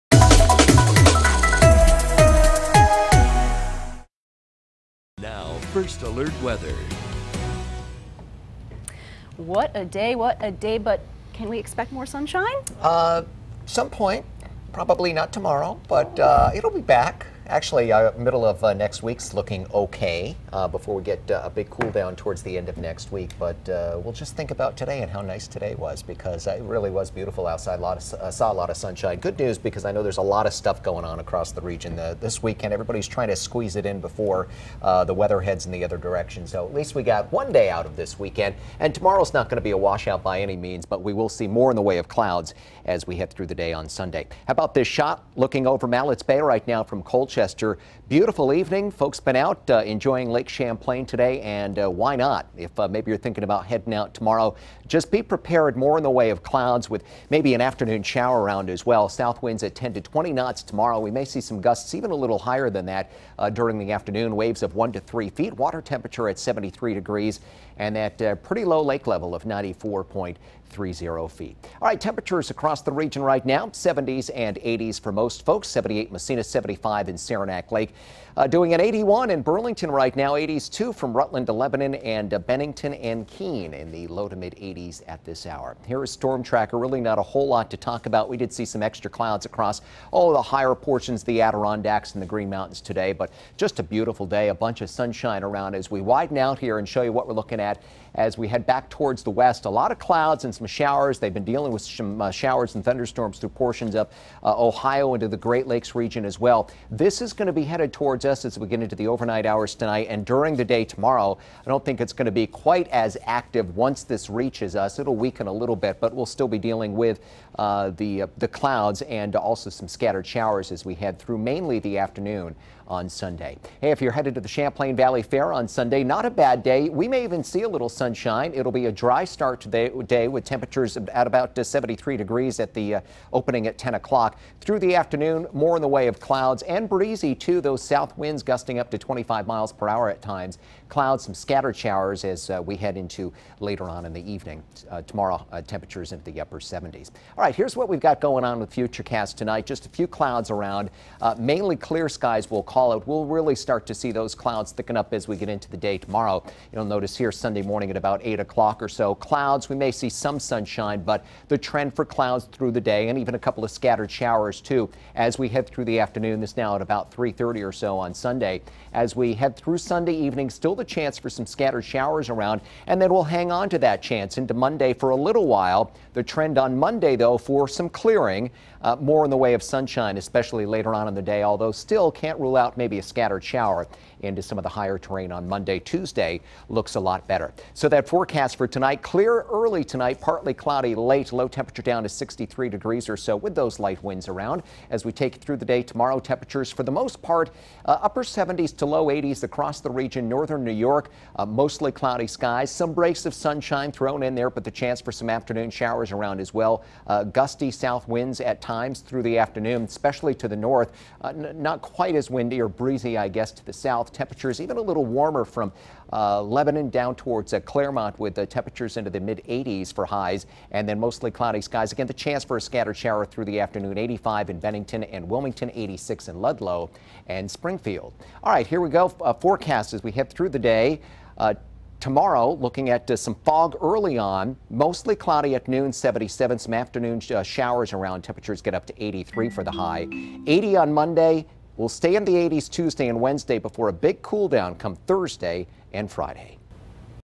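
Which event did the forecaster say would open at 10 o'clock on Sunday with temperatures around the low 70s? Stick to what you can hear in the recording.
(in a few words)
Champlain Valley Fair.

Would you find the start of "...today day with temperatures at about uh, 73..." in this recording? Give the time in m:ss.
2:09.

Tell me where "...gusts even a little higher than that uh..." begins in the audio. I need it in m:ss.
1:01.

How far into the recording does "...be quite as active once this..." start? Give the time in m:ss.
1:52.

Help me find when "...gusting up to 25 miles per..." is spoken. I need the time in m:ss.
2:18.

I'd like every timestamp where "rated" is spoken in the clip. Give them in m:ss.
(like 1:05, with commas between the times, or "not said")
not said.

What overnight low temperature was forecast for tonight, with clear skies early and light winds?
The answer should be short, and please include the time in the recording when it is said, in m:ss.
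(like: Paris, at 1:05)
63 degrees, at 3:12.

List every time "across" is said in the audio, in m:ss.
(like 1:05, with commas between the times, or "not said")
0:31, 1:12, 1:29, 3:19.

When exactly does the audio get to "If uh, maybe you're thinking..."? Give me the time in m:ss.
0:52.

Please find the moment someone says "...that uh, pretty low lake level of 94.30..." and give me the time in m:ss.
1:07.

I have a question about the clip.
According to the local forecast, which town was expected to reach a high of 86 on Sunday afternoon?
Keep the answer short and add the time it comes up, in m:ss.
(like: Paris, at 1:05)
Ludlow, at 3:46.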